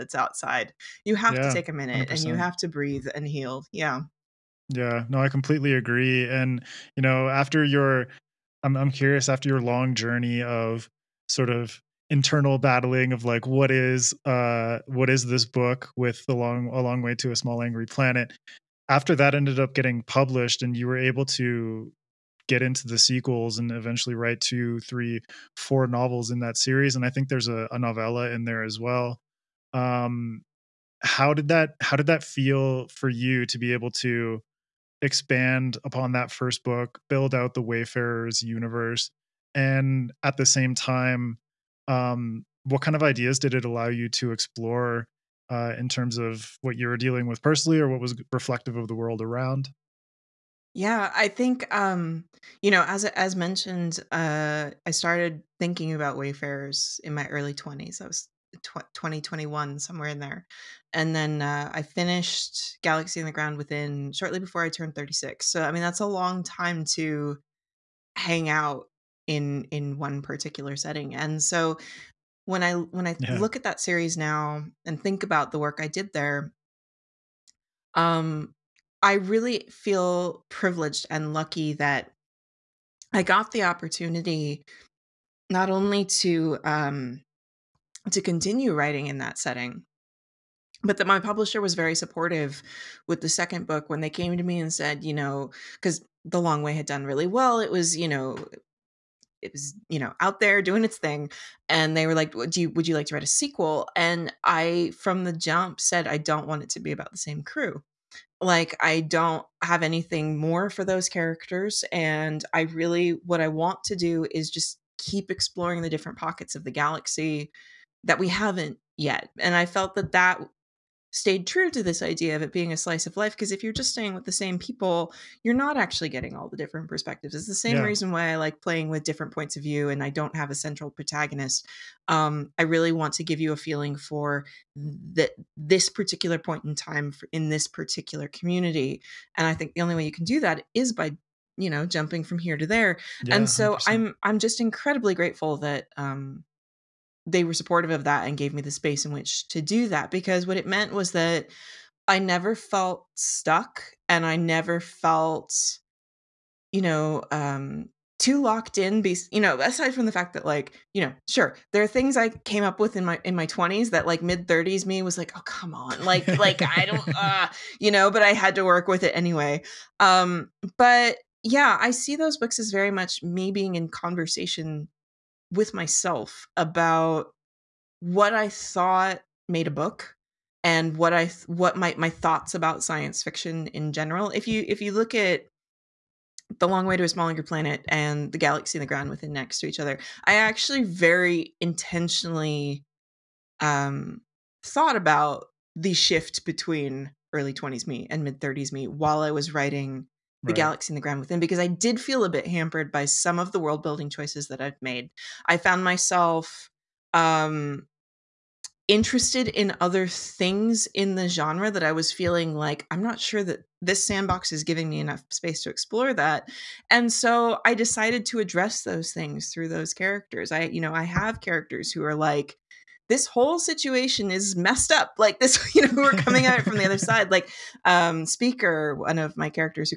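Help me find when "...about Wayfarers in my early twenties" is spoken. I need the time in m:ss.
0:55.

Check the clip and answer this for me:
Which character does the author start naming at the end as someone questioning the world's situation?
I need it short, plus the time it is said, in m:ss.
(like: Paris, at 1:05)
Speaker, at 3:48.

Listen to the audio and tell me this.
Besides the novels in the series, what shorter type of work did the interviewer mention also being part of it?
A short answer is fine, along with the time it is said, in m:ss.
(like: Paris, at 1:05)
novella, at 0:27.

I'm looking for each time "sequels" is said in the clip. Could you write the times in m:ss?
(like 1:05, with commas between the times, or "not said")
0:22, 1:43.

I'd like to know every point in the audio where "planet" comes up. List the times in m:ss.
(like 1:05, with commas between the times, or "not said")
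0:17, 3:07.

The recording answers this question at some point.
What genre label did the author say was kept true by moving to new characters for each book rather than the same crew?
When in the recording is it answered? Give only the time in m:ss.
2:02.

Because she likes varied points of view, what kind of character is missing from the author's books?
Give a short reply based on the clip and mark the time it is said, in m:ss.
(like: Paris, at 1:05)
central protagonist, at 2:10.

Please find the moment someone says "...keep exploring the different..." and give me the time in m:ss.
1:54.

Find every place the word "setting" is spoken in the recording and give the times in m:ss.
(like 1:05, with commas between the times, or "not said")
1:10, 1:29.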